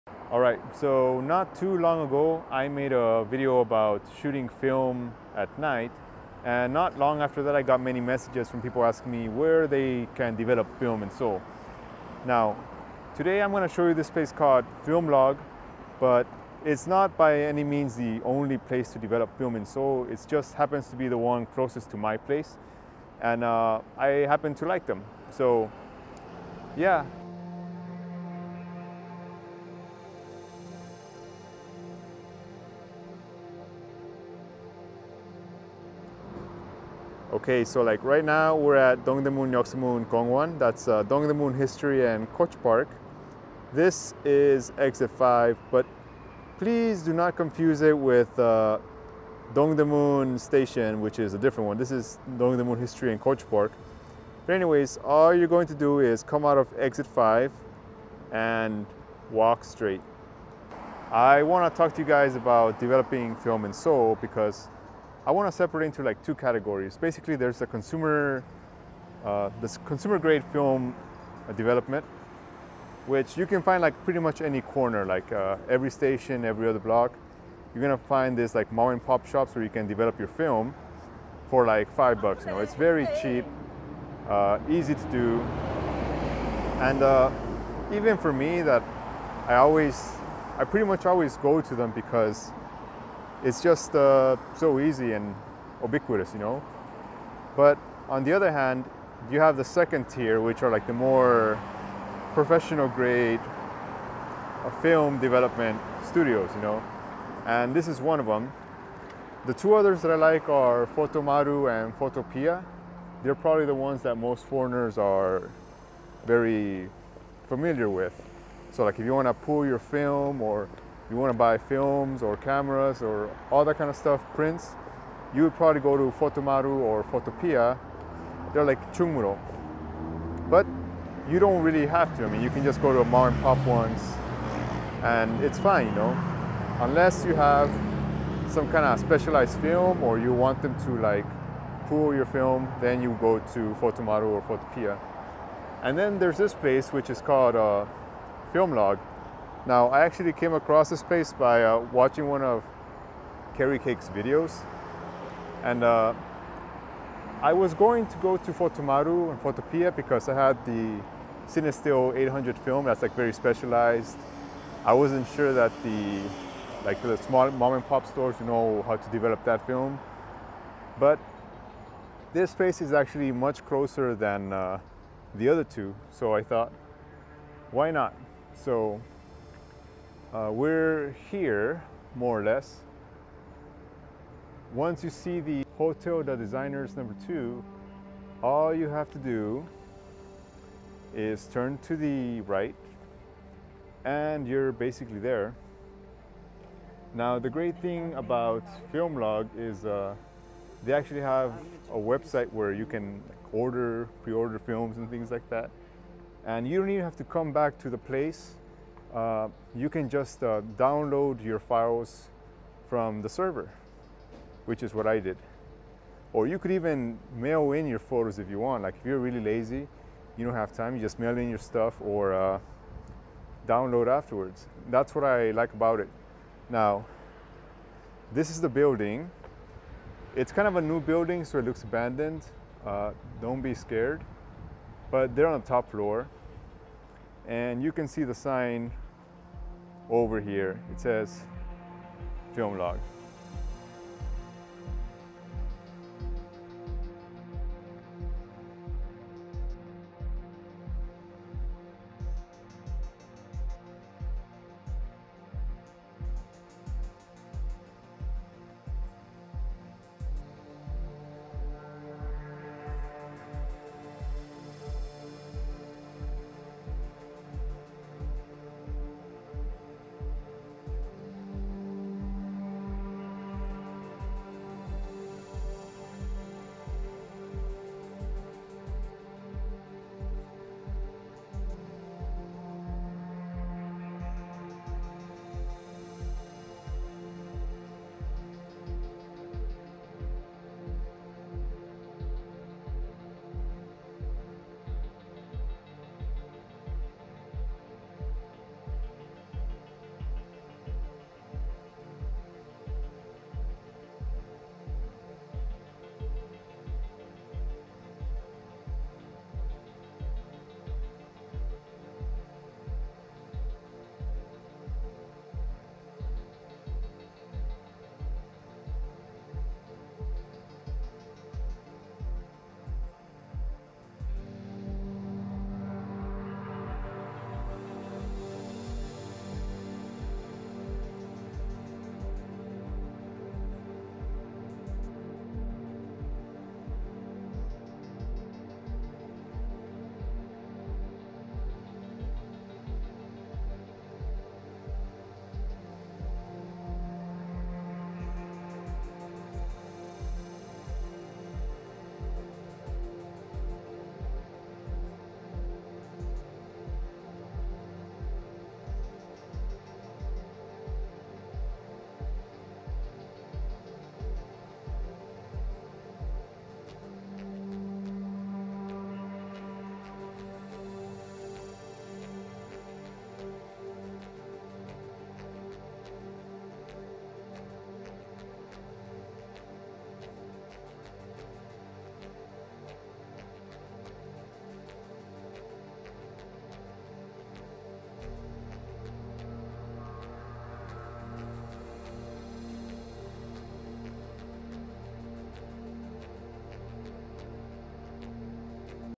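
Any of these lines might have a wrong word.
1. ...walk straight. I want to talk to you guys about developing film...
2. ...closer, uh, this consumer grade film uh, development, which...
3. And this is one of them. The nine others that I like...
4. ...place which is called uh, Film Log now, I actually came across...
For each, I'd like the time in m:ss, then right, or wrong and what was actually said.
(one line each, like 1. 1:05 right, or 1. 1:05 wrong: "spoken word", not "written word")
1. 0:59 right
2. 1:07 wrong: "consumer", not "closer"
3. 1:47 wrong: "two", not "nine"
4. 2:26 right.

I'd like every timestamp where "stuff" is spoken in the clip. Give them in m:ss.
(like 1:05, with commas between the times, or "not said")
2:03, 3:41.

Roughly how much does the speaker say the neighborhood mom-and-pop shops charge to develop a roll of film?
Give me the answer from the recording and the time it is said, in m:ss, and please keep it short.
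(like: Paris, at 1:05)
5 dollars, at 1:21.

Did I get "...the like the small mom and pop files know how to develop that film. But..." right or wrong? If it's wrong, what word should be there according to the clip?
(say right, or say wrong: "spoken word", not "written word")
wrong: "stores", not "files".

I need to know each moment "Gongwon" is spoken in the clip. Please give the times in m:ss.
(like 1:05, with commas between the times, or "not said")
0:40.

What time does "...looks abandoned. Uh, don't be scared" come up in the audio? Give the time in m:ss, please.
3:51.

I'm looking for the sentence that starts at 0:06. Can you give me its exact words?
And not long after that, I got many messages from people asking me where they can develop film in Seoul.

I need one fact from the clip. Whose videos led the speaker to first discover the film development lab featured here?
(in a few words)
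Cari Cake.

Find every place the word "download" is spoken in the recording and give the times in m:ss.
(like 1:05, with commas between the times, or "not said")
3:30, 3:43.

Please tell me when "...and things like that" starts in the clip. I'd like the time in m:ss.
3:24.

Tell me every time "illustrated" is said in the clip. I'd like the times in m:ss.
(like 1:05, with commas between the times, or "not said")
not said.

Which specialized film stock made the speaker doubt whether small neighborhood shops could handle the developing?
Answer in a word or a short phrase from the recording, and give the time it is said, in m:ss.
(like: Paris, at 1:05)
Cinestill 800, at 2:41.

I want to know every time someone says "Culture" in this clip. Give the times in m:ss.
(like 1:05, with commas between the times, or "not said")
0:42, 0:53.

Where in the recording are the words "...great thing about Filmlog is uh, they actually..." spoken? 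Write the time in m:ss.
3:17.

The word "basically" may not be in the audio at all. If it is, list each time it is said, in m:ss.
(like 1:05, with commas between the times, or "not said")
1:06, 3:14.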